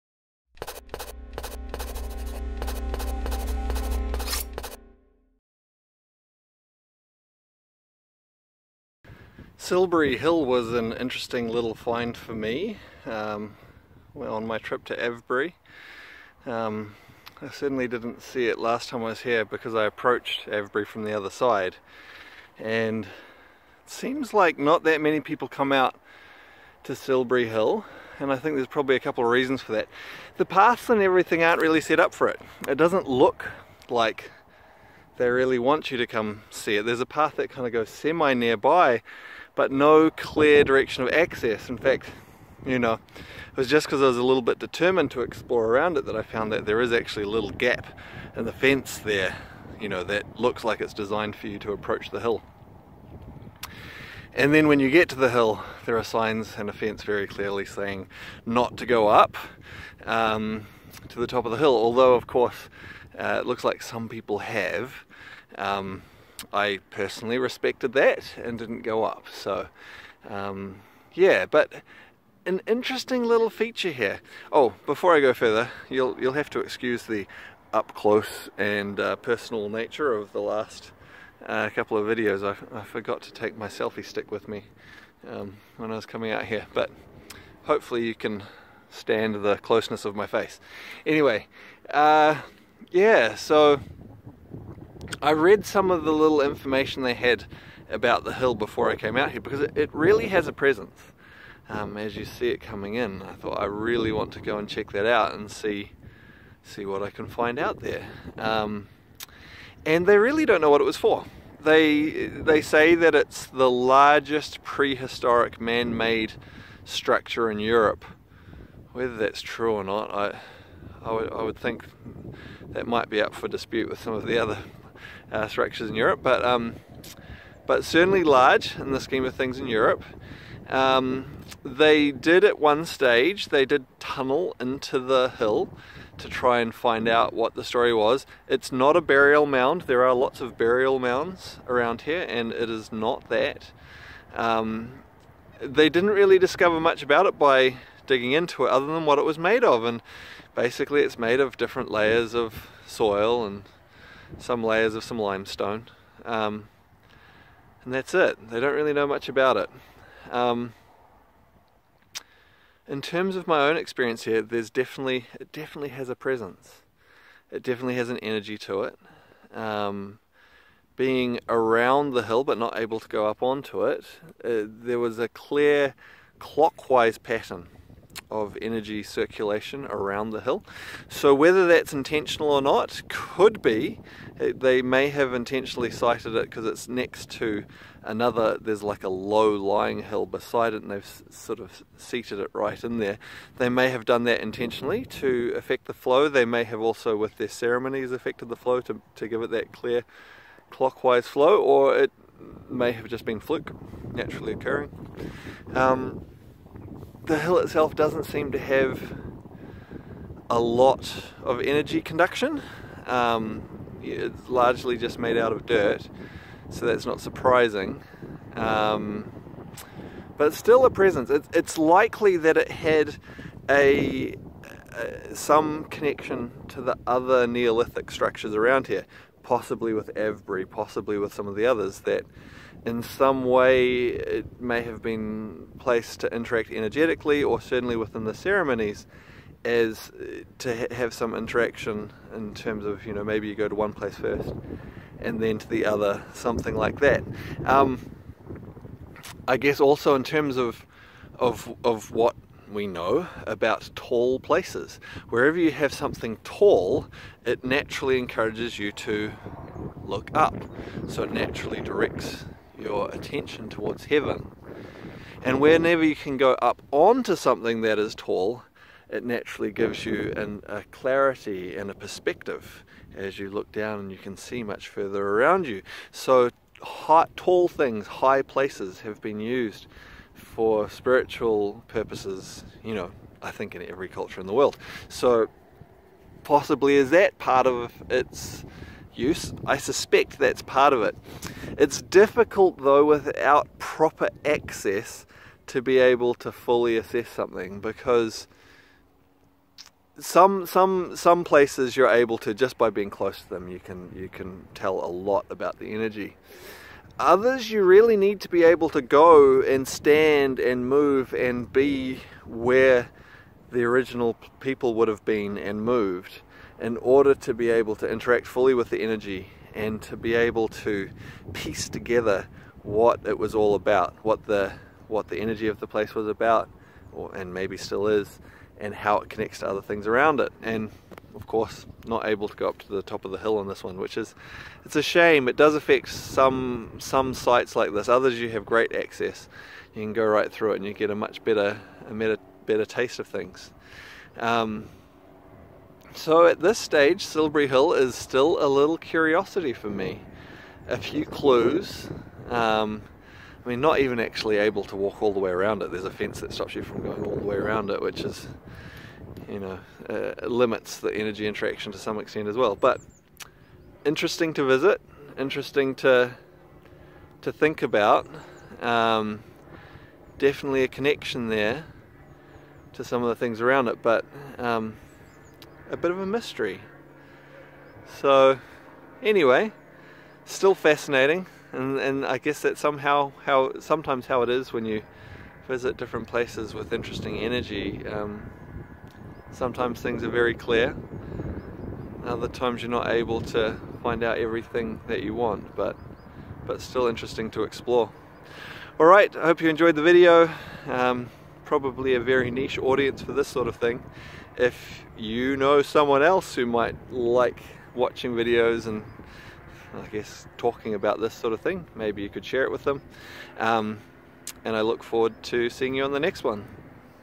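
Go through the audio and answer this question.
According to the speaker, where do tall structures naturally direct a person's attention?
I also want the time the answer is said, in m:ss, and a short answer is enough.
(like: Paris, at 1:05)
towards heaven, at 4:23.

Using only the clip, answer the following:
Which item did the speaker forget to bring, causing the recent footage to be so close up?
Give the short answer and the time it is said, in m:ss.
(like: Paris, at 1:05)
selfie stick, at 1:23.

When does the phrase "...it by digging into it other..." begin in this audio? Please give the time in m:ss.
2:27.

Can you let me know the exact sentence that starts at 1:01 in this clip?
Although, of course, uh, it looks like some people have.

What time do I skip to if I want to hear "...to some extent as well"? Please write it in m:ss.
6:01.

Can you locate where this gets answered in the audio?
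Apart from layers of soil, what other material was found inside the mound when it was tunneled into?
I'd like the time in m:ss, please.
2:35.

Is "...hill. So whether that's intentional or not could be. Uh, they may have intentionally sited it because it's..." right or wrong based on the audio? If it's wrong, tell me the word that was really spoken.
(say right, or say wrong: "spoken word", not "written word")
right.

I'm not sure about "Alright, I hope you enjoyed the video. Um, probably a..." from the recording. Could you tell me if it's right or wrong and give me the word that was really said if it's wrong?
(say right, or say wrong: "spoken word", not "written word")
right.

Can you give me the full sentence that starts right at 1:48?
Um, and they really don't know what it was for.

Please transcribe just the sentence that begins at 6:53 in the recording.
Um, and I look forward to seeing you on the next one.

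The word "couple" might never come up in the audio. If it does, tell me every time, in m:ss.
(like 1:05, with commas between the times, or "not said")
0:28, 1:21.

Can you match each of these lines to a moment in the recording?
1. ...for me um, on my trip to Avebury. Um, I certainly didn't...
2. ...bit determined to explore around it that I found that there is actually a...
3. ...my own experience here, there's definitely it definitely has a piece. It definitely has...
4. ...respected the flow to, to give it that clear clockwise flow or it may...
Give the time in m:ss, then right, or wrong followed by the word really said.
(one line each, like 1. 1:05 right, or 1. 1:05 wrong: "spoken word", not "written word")
1. 0:12 right
2. 0:44 right
3. 2:43 wrong: "presence", not "piece"
4. 3:18 wrong: "affected", not "respected".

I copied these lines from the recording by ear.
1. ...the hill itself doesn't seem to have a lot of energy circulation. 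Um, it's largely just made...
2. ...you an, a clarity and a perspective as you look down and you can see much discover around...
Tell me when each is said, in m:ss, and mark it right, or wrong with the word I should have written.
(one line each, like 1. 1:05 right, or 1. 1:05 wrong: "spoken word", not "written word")
1. 3:27 wrong: "conduction", not "circulation"
2. 4:30 wrong: "further", not "discover".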